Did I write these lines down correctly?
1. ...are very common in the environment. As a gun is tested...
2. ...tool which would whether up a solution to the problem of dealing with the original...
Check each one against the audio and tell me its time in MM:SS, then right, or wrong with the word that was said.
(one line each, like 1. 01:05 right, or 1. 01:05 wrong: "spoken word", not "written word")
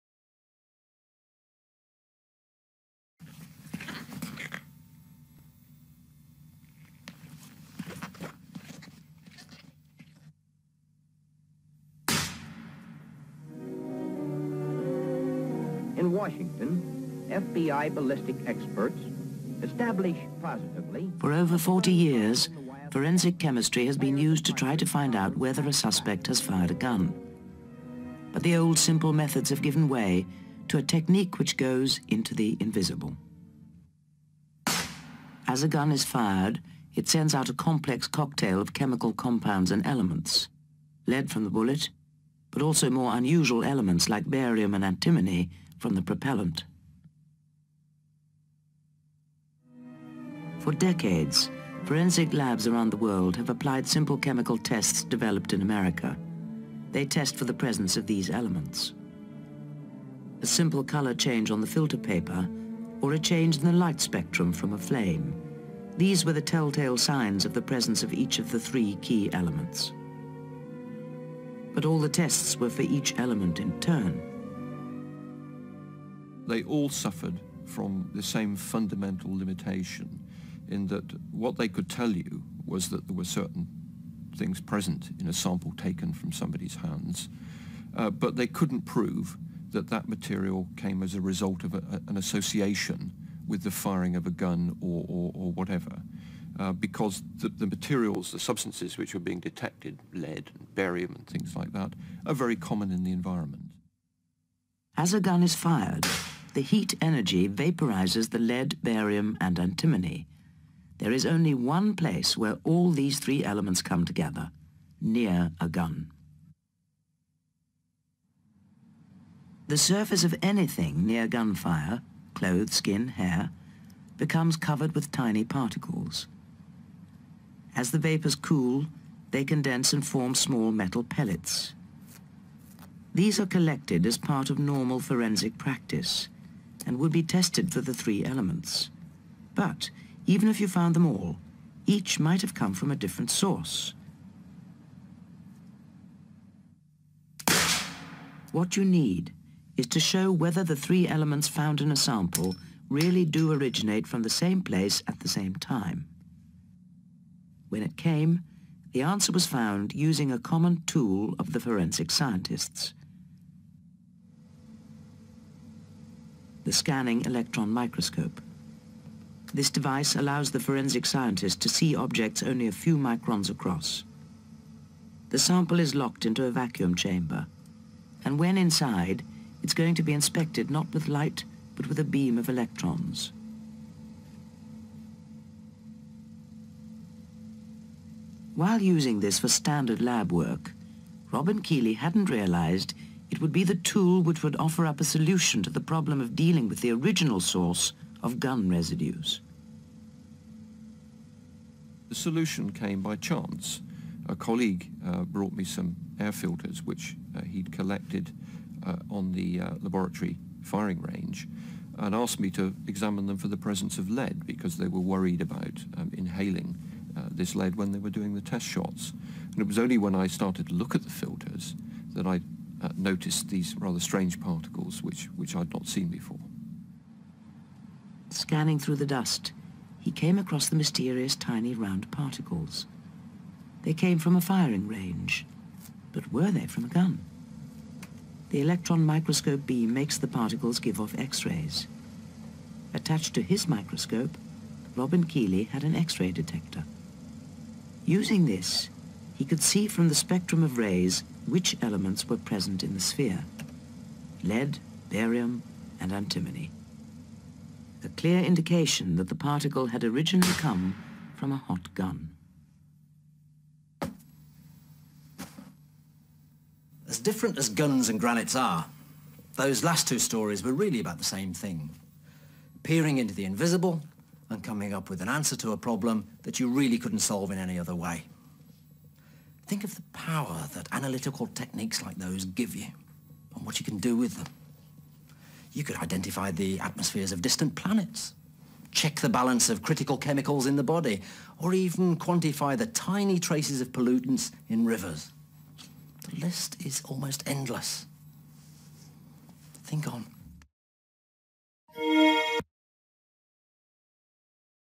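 1. 01:42 wrong: "fired", not "tested"
2. 03:13 wrong: "offer", not "whether".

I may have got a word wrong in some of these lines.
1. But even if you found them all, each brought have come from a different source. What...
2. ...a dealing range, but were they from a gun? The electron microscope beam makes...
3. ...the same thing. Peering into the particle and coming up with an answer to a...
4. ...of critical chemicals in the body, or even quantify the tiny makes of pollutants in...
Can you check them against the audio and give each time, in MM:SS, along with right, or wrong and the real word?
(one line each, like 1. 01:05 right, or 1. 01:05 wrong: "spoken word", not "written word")
1. 02:19 wrong: "might", not "brought"
2. 03:54 wrong: "firing", not "dealing"
3. 04:31 wrong: "invisible", not "particle"
4. 04:49 wrong: "traces", not "makes".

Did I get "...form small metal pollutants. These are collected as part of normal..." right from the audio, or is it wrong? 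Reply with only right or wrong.
wrong.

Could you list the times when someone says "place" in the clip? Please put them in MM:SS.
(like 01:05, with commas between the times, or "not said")
01:51, 02:34.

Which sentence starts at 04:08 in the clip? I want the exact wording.
Using this, he could see from the spectrum of rays which elements were present in the sphere.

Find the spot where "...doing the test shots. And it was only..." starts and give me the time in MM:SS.
03:38.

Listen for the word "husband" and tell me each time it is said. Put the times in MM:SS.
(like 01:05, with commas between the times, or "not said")
not said.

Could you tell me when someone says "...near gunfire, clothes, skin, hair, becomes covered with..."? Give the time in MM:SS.
02:01.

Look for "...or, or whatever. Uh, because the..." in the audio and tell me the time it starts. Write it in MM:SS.
01:35.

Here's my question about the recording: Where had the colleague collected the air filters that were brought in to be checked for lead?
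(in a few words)
laboratory firing range.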